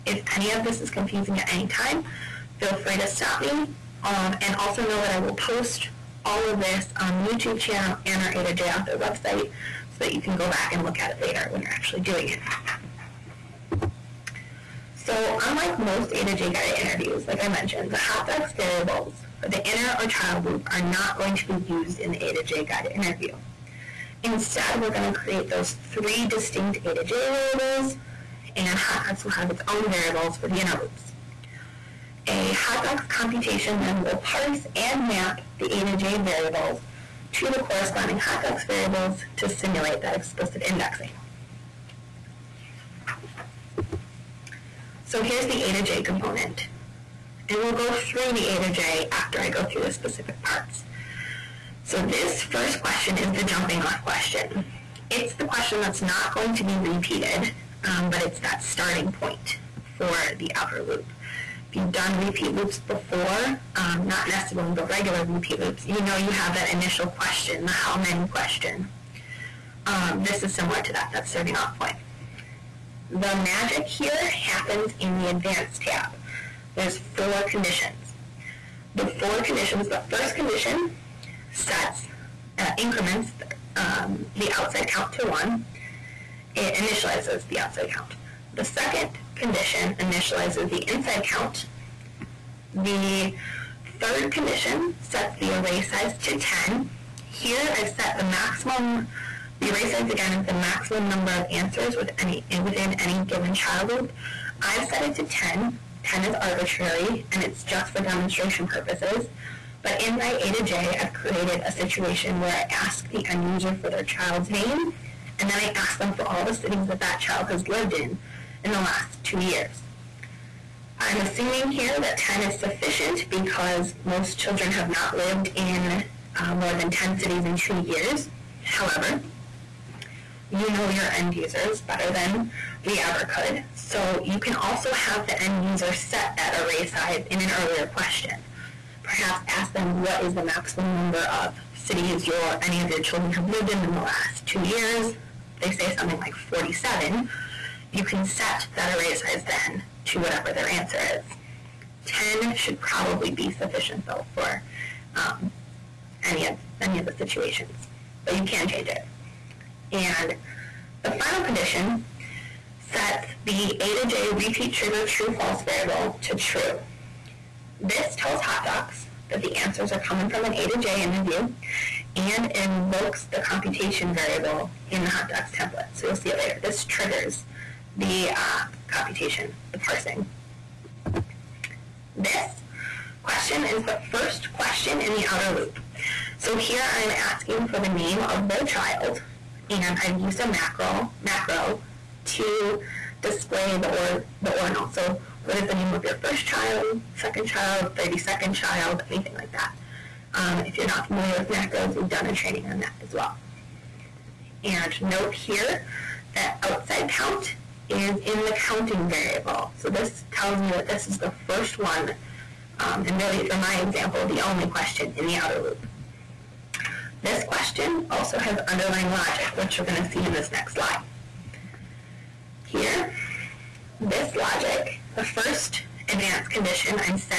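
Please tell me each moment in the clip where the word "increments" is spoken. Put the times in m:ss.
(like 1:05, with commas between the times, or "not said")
1:22.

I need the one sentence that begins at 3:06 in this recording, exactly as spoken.
So here I'm asking for the name of their child, and I've used a macro, macro to display the, or, the ordinal.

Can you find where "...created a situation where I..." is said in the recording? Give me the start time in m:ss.
1:51.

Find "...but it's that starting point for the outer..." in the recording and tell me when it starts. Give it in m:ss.
0:58.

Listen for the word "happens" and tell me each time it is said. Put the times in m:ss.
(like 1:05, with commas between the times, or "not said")
1:14.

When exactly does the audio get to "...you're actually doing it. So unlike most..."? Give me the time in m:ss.
0:11.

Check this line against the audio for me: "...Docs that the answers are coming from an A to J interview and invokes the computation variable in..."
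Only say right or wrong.
right.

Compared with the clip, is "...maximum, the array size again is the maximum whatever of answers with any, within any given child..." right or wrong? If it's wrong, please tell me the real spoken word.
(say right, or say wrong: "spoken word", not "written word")
wrong: "number", not "whatever".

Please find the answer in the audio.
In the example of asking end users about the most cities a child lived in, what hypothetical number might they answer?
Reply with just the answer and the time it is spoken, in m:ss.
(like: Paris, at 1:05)
47, at 2:26.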